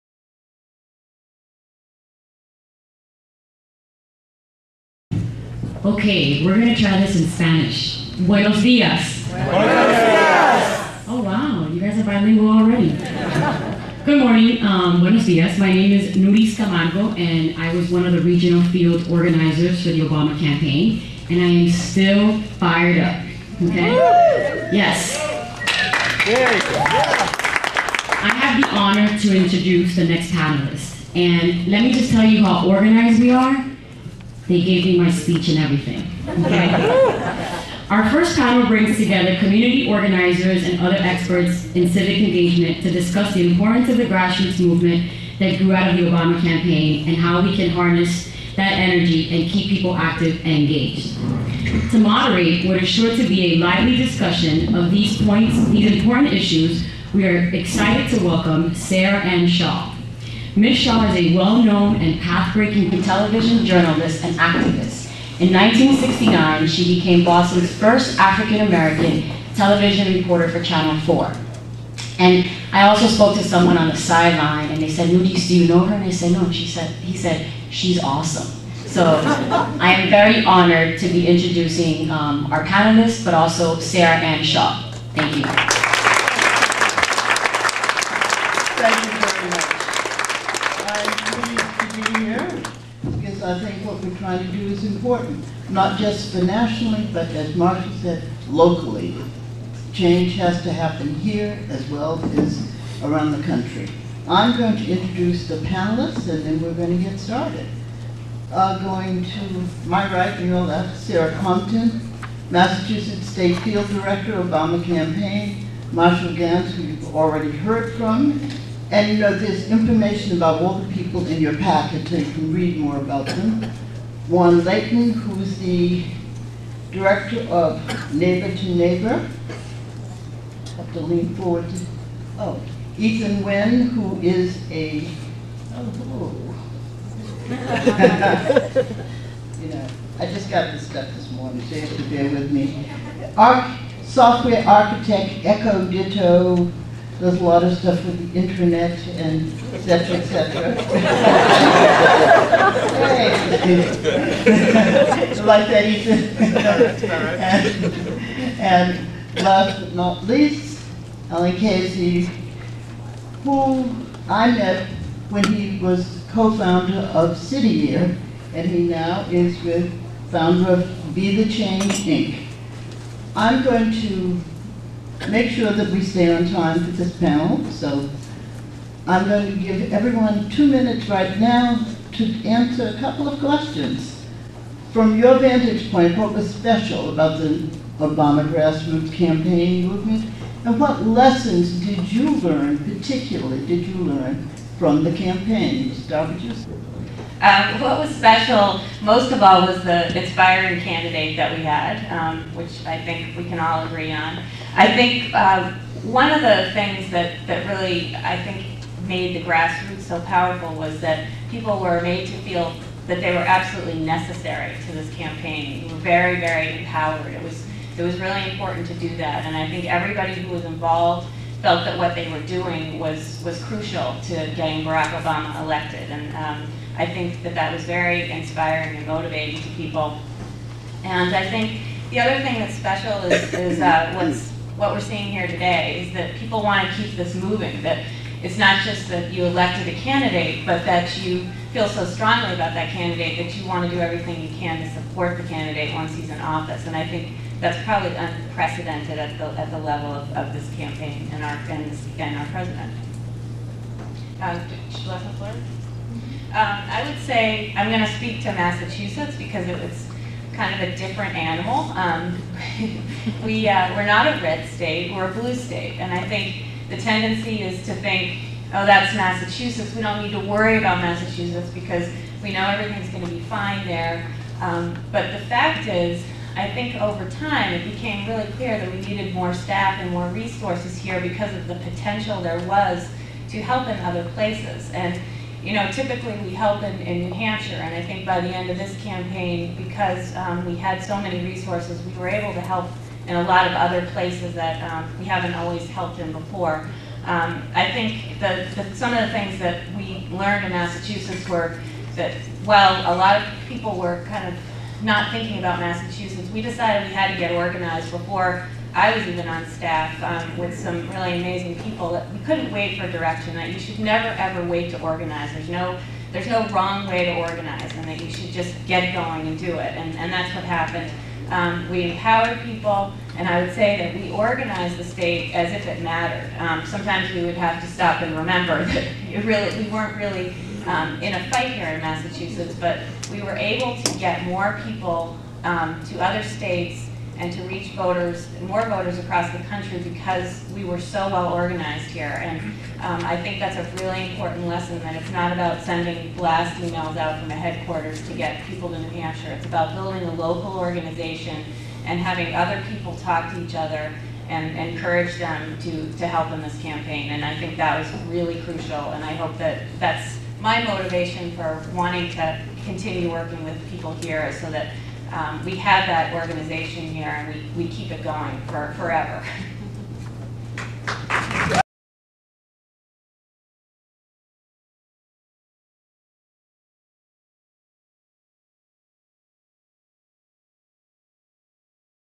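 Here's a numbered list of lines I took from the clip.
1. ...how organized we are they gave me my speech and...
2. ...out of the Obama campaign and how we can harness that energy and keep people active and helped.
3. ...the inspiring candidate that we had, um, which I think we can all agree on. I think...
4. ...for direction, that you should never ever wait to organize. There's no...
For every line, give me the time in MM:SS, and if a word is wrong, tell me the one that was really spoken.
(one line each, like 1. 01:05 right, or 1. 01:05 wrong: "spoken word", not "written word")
1. 00:32 right
2. 00:45 wrong: "engaged", not "helped"
3. 03:19 right
4. 05:12 right.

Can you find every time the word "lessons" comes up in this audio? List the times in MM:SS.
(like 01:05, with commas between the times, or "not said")
03:11, 05:44.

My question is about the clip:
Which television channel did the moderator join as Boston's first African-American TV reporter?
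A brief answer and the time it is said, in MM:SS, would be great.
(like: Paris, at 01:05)
Channel 4, at 01:10.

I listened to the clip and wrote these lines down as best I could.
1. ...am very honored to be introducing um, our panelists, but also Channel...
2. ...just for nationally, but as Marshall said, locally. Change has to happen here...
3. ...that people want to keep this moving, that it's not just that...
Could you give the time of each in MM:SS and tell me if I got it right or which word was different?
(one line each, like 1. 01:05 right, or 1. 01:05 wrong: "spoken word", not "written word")
1. 01:19 wrong: "Sarah", not "Channel"
2. 01:35 right
3. 03:56 right.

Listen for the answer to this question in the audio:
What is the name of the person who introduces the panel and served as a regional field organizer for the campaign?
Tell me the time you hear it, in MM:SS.
00:16.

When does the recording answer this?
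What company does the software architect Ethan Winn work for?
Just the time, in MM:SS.
02:25.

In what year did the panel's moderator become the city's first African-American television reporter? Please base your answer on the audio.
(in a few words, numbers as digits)
1969.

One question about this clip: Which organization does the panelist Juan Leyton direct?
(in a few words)
Neighbor to Neighbor.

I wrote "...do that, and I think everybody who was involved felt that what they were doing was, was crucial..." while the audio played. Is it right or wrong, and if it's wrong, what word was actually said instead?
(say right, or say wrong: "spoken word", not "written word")
right.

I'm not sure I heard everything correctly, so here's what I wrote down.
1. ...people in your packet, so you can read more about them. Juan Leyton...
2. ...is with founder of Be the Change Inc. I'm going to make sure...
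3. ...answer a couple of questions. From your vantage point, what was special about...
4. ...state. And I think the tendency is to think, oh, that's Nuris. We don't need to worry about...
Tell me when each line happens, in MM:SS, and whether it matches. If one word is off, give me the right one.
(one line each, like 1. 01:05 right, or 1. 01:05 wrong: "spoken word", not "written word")
1. 02:00 right
2. 02:49 right
3. 03:02 right
4. 04:25 wrong: "Massachusetts", not "Nuris".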